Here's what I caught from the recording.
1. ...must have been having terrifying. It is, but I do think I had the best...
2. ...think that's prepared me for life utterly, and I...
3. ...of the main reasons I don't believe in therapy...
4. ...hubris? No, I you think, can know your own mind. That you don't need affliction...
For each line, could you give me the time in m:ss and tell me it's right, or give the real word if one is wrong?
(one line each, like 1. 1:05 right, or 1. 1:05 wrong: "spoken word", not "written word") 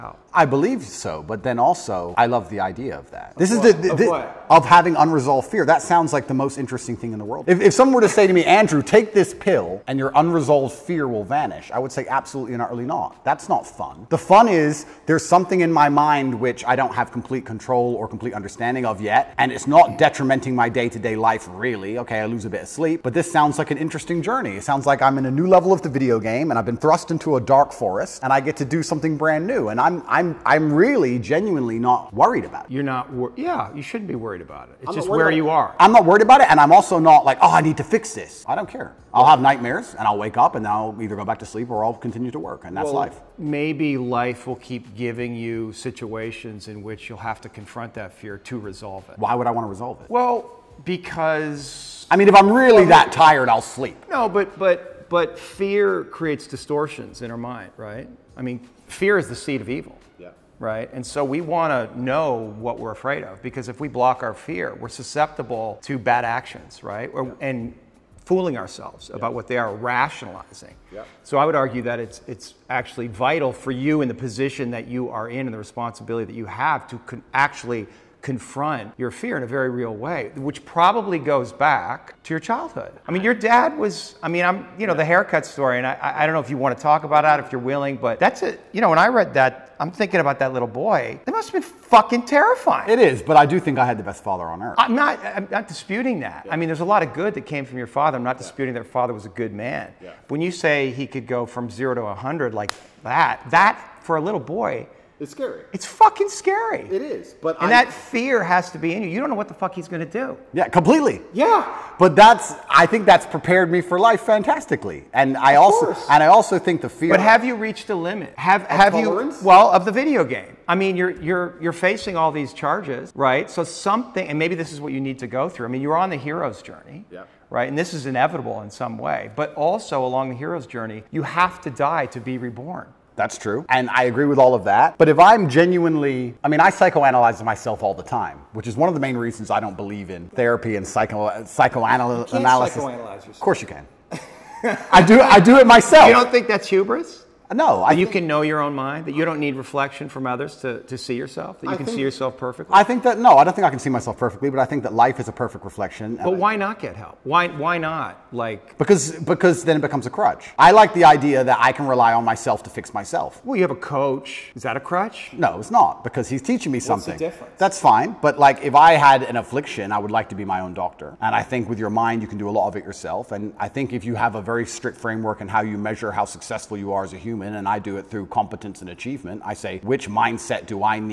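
1. 1:31 wrong: "fucking", not "having"
2. 1:52 wrong: "fantastically", not "utterly"
3. 2:18 right
4. 2:26 wrong: "reflection", not "affliction".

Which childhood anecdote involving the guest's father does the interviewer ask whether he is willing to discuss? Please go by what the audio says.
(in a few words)
the haircut story.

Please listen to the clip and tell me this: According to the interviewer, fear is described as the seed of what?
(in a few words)
evil.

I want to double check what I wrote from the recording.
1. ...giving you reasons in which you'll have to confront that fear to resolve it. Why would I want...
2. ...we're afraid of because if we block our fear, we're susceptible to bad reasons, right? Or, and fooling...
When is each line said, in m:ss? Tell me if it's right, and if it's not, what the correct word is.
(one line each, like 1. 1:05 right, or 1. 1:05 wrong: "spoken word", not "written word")
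1. 0:44 wrong: "situations", not "reasons"
2. 1:02 wrong: "actions", not "reasons".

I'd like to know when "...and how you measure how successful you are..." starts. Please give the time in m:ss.
2:55.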